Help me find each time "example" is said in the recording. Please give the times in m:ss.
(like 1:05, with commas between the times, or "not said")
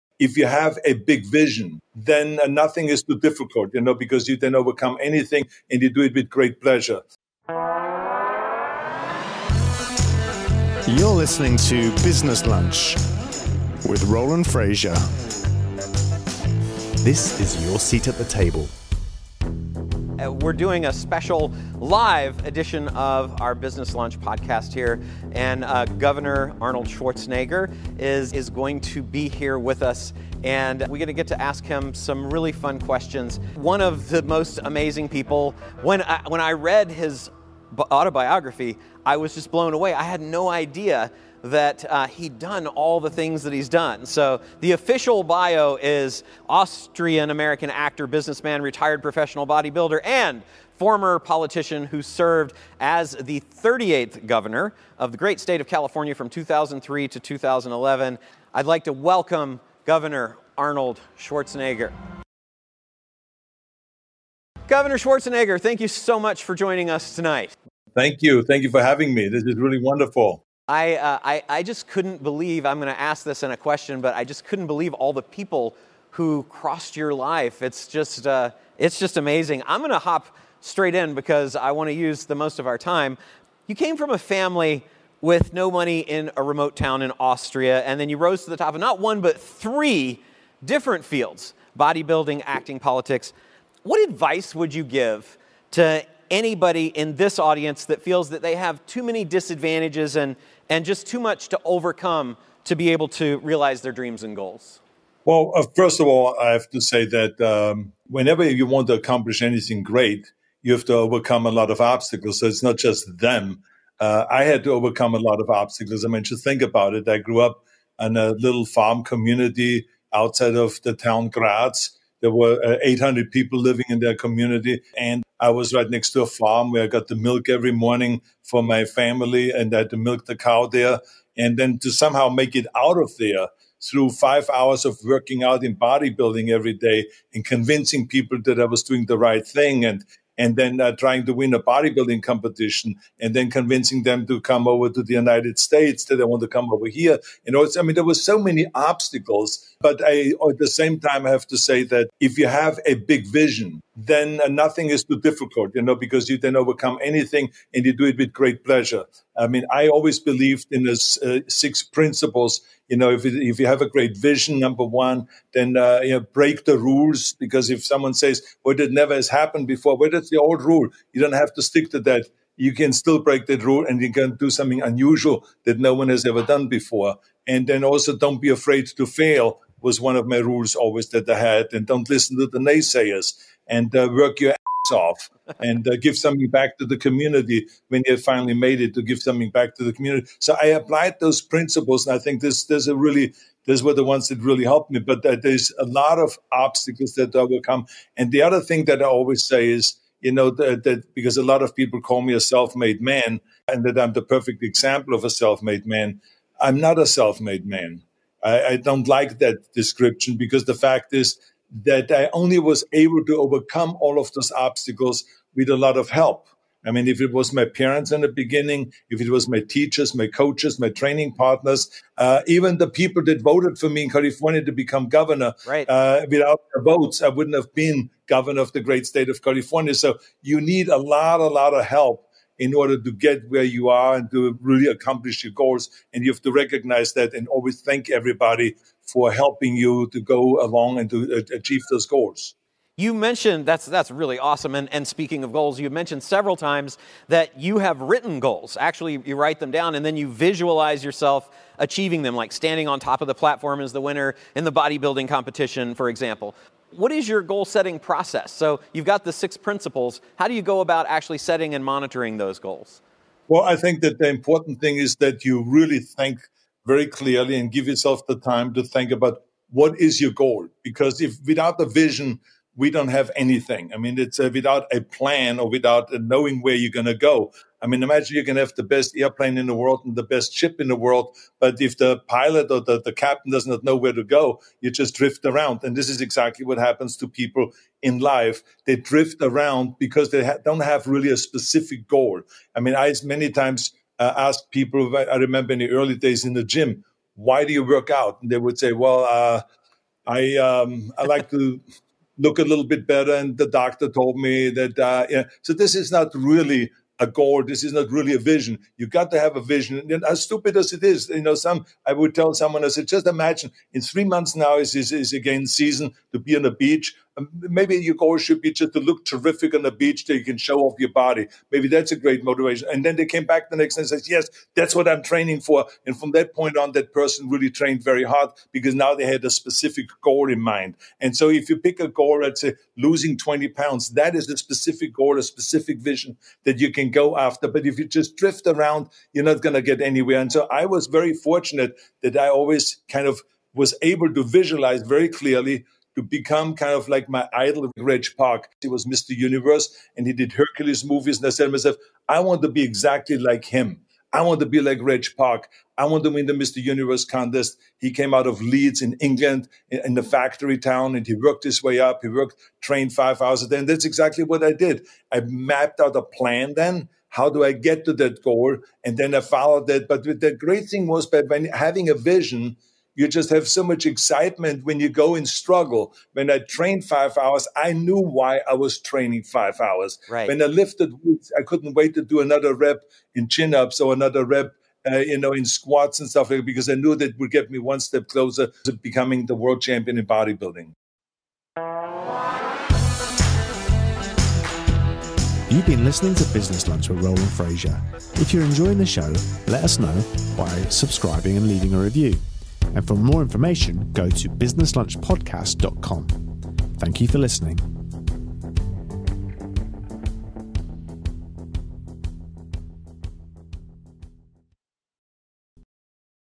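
3:24, 4:16.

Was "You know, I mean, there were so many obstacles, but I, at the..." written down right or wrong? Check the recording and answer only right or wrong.
right.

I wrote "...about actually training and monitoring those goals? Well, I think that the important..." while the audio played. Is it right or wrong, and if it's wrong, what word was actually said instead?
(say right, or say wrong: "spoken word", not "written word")
wrong: "setting", not "training".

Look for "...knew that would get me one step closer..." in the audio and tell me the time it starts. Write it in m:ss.
6:26.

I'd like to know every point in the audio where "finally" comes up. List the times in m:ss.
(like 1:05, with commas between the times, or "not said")
3:08.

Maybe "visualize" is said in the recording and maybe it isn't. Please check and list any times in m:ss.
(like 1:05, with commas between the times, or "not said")
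4:10, 5:44.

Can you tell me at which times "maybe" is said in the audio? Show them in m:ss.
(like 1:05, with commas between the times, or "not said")
5:17, 5:21.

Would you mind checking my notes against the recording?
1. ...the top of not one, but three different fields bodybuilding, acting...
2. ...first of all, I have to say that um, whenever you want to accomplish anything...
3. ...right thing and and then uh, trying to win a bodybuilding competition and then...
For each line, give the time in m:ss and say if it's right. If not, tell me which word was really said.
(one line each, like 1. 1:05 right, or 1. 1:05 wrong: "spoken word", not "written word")
1. 1:28 right
2. 1:45 right
3. 2:19 right.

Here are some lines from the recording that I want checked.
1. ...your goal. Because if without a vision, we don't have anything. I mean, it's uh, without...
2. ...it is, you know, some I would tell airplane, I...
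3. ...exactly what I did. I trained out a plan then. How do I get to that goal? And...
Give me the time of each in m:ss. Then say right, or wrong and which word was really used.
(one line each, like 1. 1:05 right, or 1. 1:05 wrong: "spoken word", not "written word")
1. 4:30 right
2. 5:10 wrong: "someone", not "airplane"
3. 6:04 wrong: "mapped", not "trained".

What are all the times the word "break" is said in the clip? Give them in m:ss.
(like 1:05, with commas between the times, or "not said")
2:46, 2:53.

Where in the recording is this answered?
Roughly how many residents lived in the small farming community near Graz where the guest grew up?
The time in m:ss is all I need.
2:02.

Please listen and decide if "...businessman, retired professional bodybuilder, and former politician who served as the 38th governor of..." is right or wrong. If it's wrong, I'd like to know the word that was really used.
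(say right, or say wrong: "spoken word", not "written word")
right.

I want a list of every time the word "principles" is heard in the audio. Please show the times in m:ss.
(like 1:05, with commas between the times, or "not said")
2:41, 3:11, 4:19.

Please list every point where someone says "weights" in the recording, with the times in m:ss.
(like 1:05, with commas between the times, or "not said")
6:21.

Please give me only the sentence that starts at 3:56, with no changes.
And you have to recognize that and always thank everybody for helping you to go along and to uh, achieve those goals.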